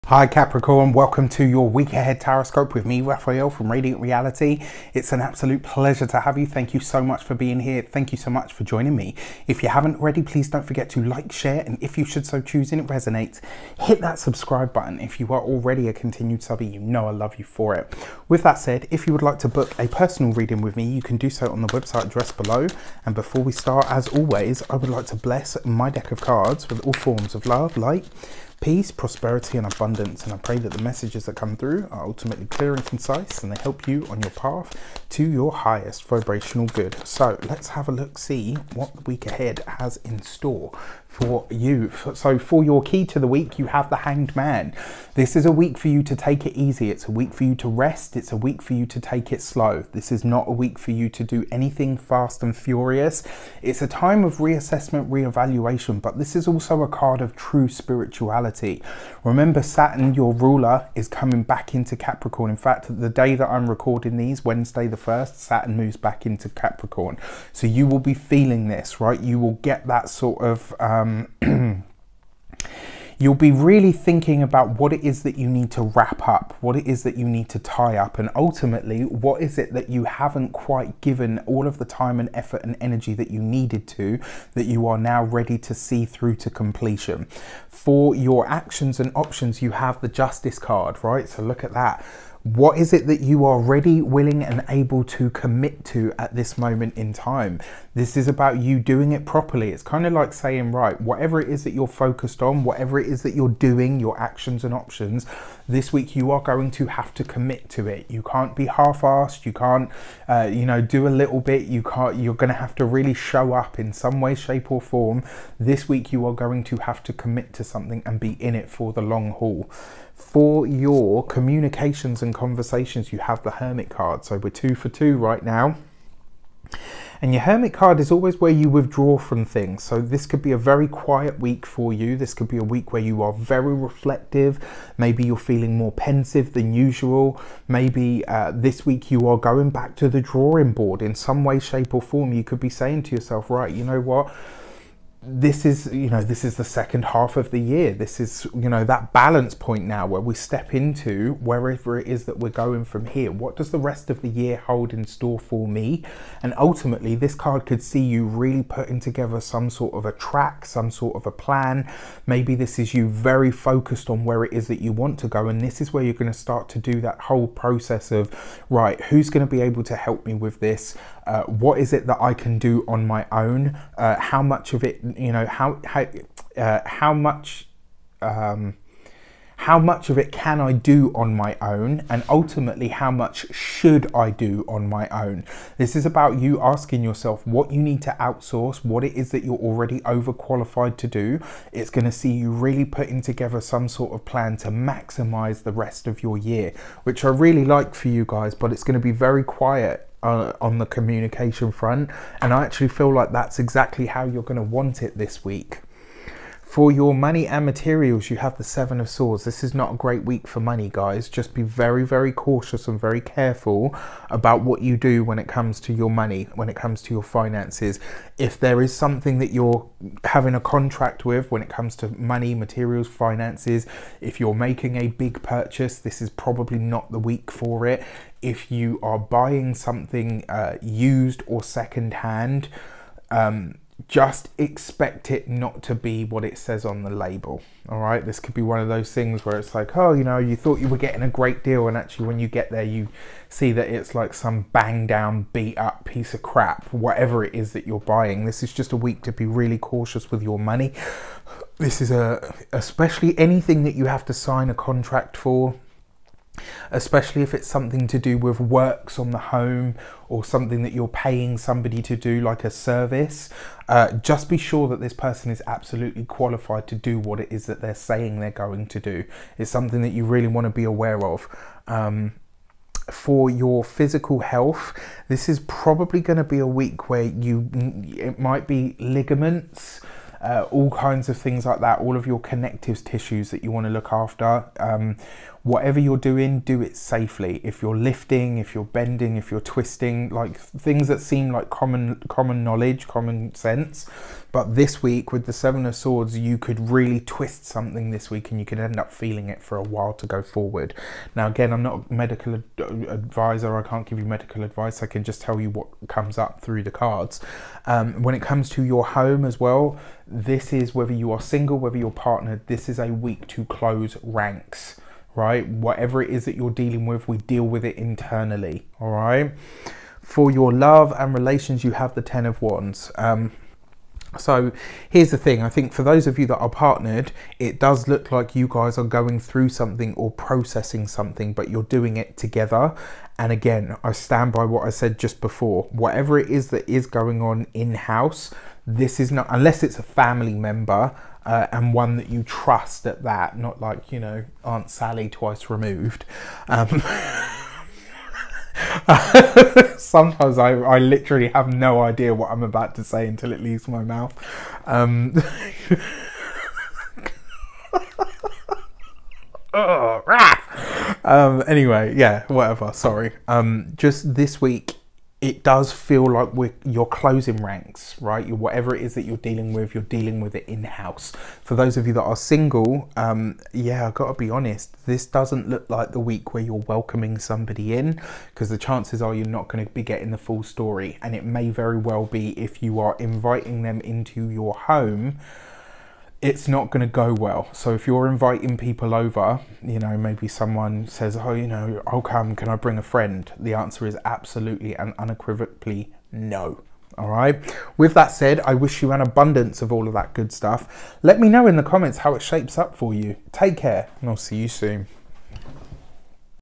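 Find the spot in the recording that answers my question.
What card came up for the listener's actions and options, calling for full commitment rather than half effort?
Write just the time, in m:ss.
1:30.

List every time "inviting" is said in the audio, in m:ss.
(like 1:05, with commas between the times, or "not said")
6:23, 6:28.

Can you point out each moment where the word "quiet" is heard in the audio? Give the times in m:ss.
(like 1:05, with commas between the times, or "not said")
2:10, 3:19.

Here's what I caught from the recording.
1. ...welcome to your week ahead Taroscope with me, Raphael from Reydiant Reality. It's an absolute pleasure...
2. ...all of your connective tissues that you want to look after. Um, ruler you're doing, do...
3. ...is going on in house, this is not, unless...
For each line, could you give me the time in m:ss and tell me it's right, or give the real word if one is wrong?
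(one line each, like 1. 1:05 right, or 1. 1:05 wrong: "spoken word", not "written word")
1. 0:00 right
2. 4:41 wrong: "whatever", not "ruler"
3. 5:36 right.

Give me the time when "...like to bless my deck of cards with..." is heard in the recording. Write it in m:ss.
0:24.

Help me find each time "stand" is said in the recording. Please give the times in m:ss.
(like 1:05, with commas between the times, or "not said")
5:34.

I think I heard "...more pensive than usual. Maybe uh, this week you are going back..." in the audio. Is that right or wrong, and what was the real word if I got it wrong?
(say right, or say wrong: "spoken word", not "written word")
right.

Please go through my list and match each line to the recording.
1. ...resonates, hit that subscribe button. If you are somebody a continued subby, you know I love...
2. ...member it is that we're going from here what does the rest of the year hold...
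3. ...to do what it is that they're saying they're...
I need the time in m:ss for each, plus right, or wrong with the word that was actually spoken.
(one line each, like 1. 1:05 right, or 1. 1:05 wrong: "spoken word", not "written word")
1. 0:12 wrong: "already", not "somebody"
2. 2:31 wrong: "wherever", not "member"
3. 4:26 right.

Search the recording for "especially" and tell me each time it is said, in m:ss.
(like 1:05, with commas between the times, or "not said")
4:12, 4:16.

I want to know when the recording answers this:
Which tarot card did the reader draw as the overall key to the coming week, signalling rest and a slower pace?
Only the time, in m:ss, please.
0:43.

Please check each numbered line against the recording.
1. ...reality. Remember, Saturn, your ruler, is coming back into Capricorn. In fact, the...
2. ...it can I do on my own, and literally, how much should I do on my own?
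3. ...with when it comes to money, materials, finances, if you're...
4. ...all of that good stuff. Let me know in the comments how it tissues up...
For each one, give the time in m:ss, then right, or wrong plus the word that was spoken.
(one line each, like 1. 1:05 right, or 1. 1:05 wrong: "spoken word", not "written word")
1. 0:58 right
2. 3:00 wrong: "ultimately", not "literally"
3. 3:41 right
4. 6:39 wrong: "shapes", not "tissues".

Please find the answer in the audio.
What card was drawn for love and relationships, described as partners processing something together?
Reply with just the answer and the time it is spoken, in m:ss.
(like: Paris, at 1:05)
Ten of Wands, at 5:22.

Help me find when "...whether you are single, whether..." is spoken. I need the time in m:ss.
5:10.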